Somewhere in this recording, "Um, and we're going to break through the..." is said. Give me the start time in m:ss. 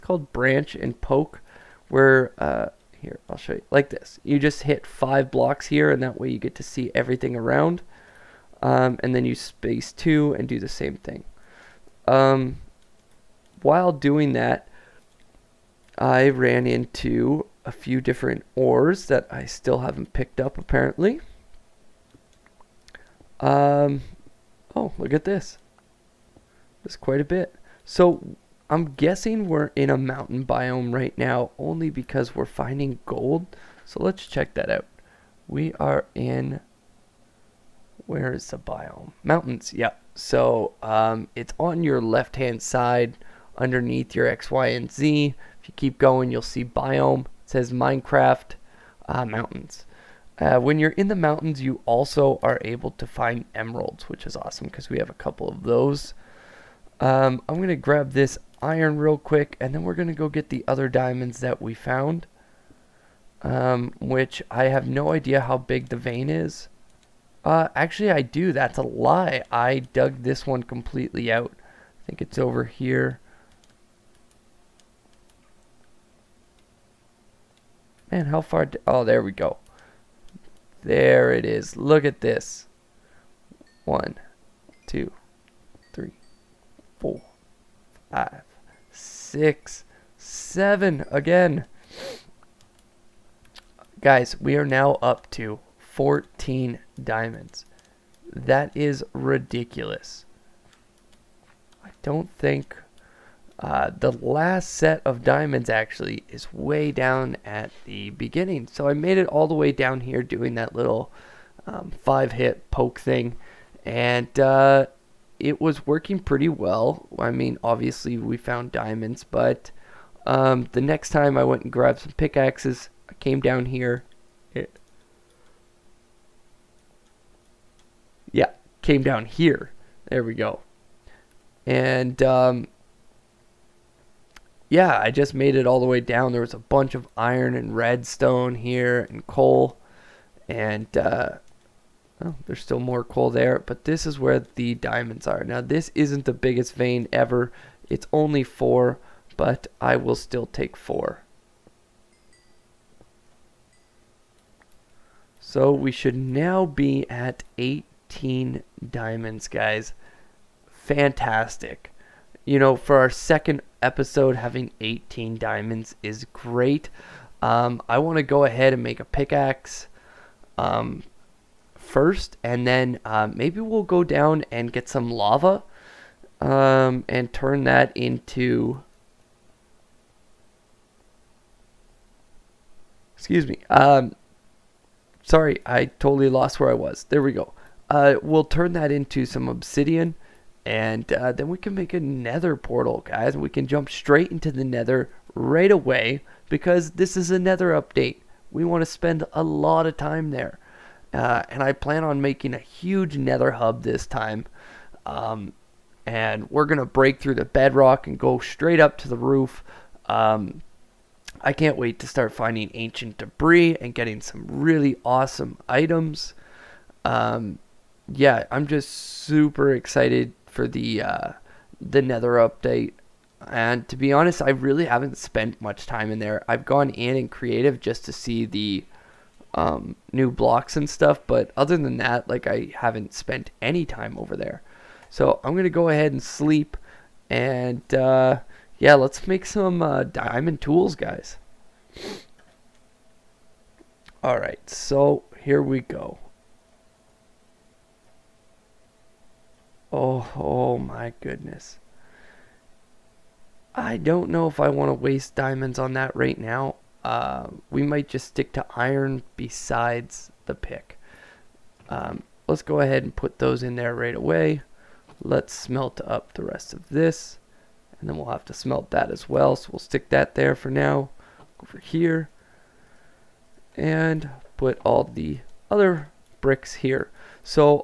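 3:25.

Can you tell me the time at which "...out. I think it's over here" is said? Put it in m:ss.
1:11.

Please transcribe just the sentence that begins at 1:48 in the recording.
So I made it all the way down here doing that little um, five hit poke thing.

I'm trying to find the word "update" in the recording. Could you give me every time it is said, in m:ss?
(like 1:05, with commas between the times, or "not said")
3:17, 3:42.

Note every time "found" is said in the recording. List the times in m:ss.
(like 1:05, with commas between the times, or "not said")
1:01, 1:58.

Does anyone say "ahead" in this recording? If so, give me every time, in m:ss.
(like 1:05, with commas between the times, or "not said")
2:48, 3:55, 4:22.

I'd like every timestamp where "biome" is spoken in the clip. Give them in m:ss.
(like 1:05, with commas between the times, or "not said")
0:30, 0:38, 0:46.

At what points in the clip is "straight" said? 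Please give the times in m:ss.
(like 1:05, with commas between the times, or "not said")
3:13, 3:28.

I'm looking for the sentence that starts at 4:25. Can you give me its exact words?
Let's smelt up the rest of this.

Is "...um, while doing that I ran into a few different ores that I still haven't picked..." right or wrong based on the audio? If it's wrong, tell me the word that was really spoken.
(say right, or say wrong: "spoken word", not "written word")
right.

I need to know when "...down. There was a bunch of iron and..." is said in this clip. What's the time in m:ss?
2:16.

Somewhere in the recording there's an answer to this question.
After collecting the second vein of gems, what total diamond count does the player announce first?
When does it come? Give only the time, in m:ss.
1:35.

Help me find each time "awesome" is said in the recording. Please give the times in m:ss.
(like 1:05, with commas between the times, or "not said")
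0:54, 3:35.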